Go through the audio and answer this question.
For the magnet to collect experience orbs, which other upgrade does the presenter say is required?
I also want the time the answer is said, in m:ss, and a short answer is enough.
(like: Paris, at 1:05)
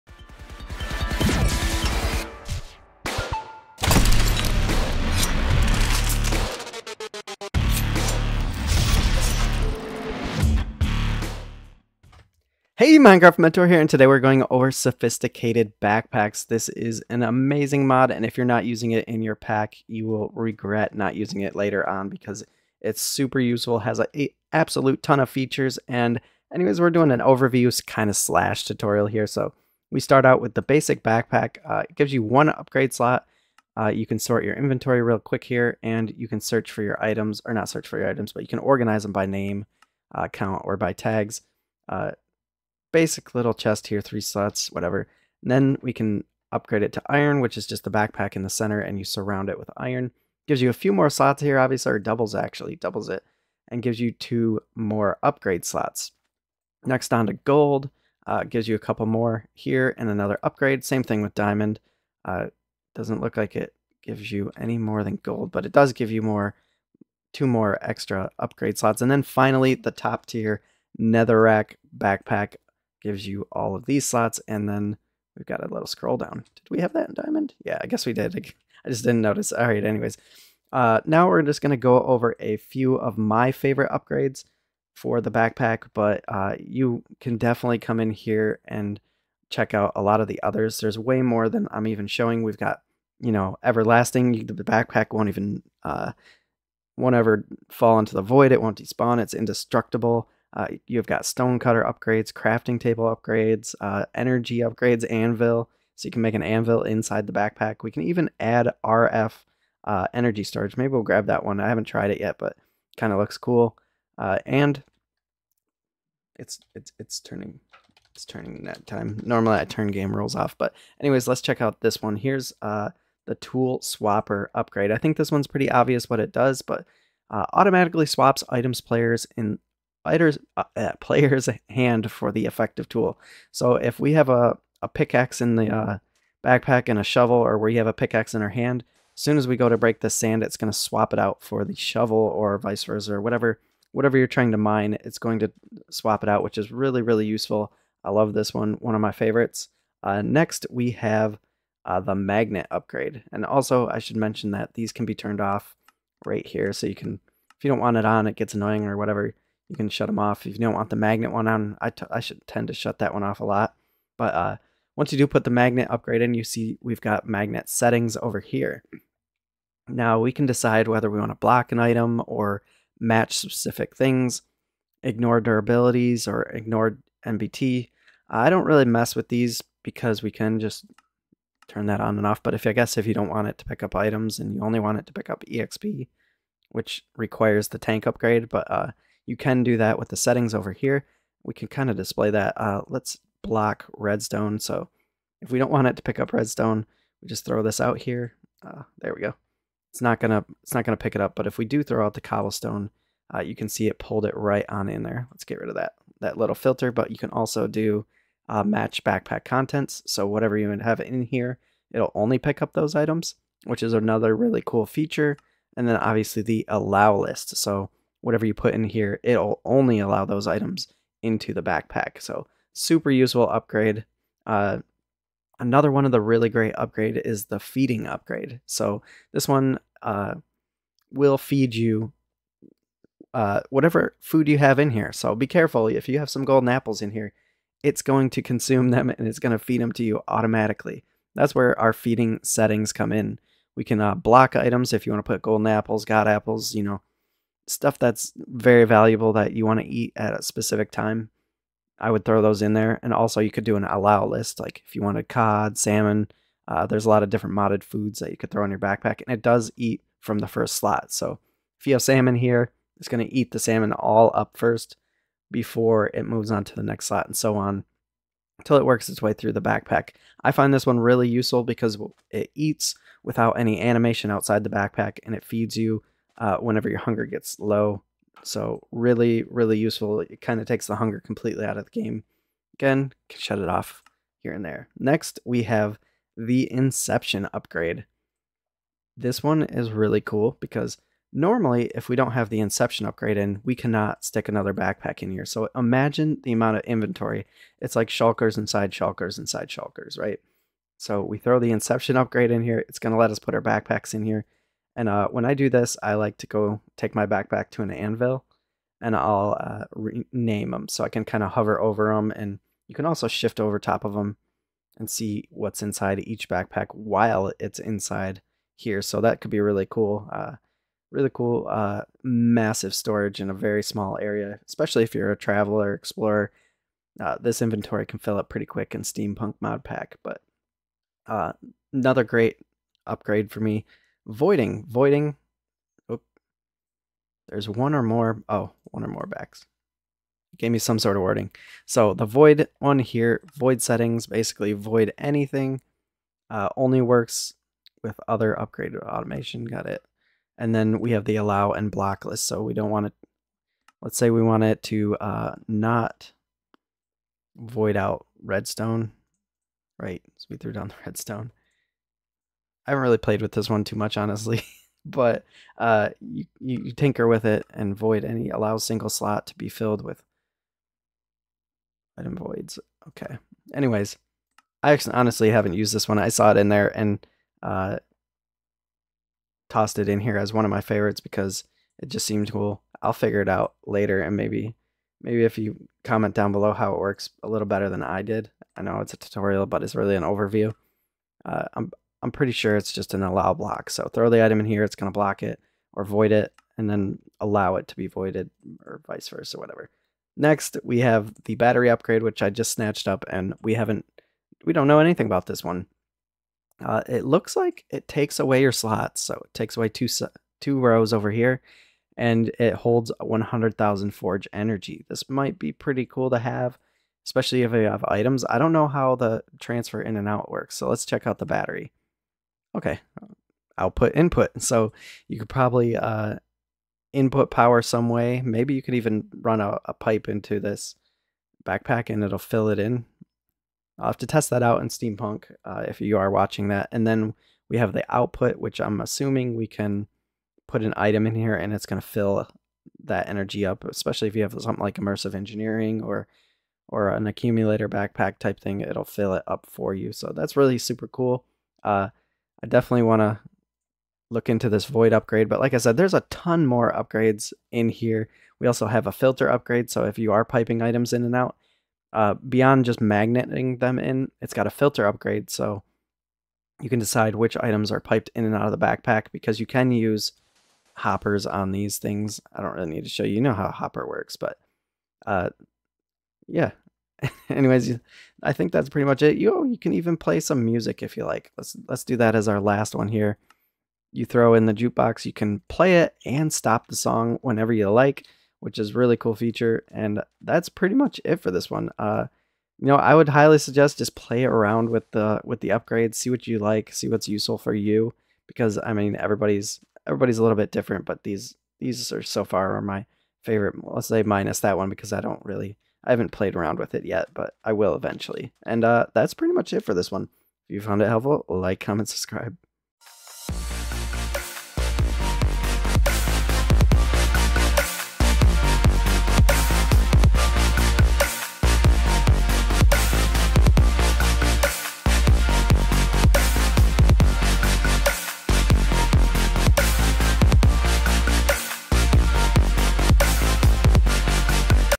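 Tank upgrade, at 3:07.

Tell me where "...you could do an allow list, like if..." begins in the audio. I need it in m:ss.
4:13.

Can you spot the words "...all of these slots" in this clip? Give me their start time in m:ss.
1:13.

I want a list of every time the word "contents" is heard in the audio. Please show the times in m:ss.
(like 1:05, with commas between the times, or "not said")
3:29.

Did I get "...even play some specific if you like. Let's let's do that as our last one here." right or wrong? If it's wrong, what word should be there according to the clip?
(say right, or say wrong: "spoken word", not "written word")
wrong: "music", not "specific".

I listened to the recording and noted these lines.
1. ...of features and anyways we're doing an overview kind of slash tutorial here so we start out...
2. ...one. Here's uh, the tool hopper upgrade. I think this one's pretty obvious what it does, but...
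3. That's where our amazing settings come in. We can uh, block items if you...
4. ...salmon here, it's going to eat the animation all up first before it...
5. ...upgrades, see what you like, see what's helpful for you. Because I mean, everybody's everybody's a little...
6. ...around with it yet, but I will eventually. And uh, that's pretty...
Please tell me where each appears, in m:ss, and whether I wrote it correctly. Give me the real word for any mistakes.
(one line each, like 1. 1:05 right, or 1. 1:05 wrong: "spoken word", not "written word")
1. 0:25 right
2. 2:02 wrong: "swapper", not "hopper"
3. 4:01 wrong: "feeding", not "amazing"
4. 4:22 wrong: "salmon", not "animation"
5. 8:15 wrong: "useful", not "helpful"
6. 8:26 right.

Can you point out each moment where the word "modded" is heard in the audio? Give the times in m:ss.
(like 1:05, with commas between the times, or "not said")
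4:17.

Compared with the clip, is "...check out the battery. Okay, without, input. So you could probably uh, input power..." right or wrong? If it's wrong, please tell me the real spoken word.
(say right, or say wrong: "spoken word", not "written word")
wrong: "output", not "without".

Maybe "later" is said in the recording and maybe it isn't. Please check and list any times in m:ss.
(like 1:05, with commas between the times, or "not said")
0:21, 6:23.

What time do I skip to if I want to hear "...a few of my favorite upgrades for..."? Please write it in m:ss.
1:22.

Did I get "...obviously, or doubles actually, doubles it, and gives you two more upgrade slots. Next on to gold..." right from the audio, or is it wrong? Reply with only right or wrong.
right.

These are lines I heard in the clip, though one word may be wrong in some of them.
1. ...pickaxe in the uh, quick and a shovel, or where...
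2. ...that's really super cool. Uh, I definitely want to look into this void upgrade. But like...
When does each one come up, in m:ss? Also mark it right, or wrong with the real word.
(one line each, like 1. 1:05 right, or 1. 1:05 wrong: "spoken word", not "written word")
1. 2:14 wrong: "backpack", not "quick"
2. 7:30 right.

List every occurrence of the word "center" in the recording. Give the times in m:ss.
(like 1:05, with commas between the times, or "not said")
0:48.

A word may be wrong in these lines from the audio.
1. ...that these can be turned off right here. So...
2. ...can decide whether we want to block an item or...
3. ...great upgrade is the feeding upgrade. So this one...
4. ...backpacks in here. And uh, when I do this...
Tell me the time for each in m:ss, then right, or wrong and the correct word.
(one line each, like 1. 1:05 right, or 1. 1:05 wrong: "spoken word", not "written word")
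1. 2:34 right
2. 2:50 right
3. 3:46 right
4. 5:03 right.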